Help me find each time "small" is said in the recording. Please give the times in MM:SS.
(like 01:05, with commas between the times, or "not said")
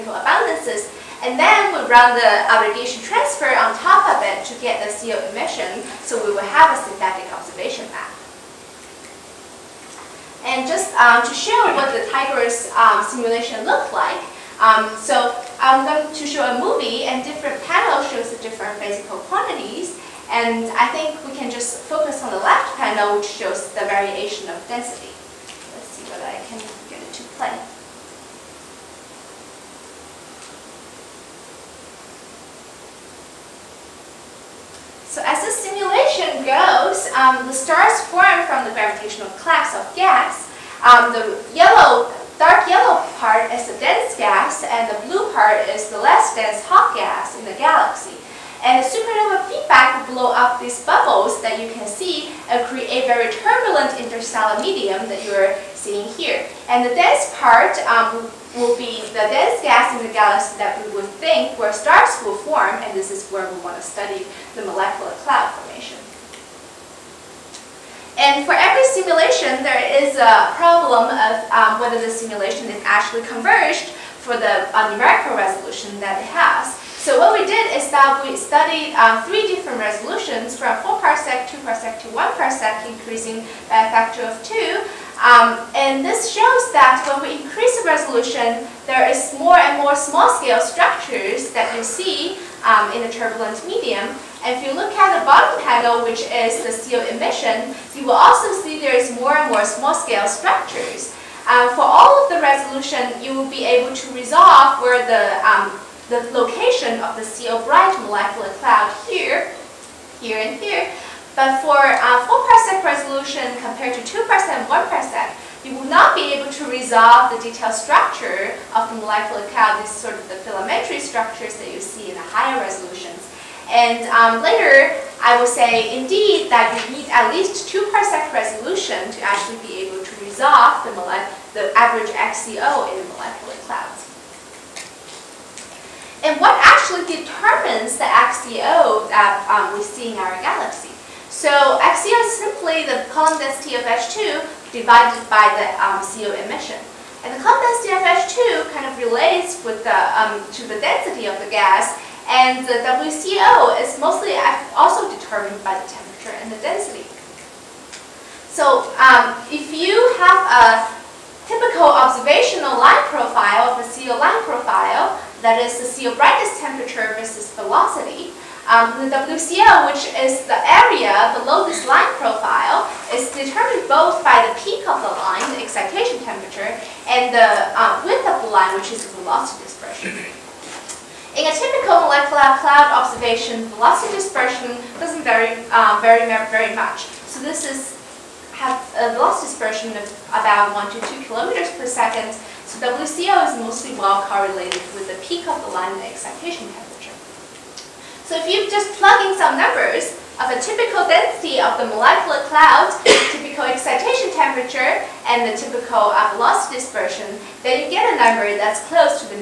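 01:29, 01:39.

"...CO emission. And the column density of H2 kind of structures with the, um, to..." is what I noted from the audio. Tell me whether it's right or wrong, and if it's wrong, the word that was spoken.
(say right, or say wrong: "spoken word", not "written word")
wrong: "relates", not "structures".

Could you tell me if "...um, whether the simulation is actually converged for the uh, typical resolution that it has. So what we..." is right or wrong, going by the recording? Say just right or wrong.
wrong.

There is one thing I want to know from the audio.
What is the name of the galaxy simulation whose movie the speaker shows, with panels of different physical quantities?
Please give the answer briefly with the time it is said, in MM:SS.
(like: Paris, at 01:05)
TIGRESS, at 00:12.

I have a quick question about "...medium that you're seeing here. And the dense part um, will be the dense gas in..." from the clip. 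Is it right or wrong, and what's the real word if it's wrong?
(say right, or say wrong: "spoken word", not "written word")
right.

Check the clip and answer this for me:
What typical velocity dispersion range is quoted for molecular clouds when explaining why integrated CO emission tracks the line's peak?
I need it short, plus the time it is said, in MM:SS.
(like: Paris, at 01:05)
1 to 2 km/s, at 03:10.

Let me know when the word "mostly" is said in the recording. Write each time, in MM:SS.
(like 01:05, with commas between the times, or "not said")
02:34, 03:13.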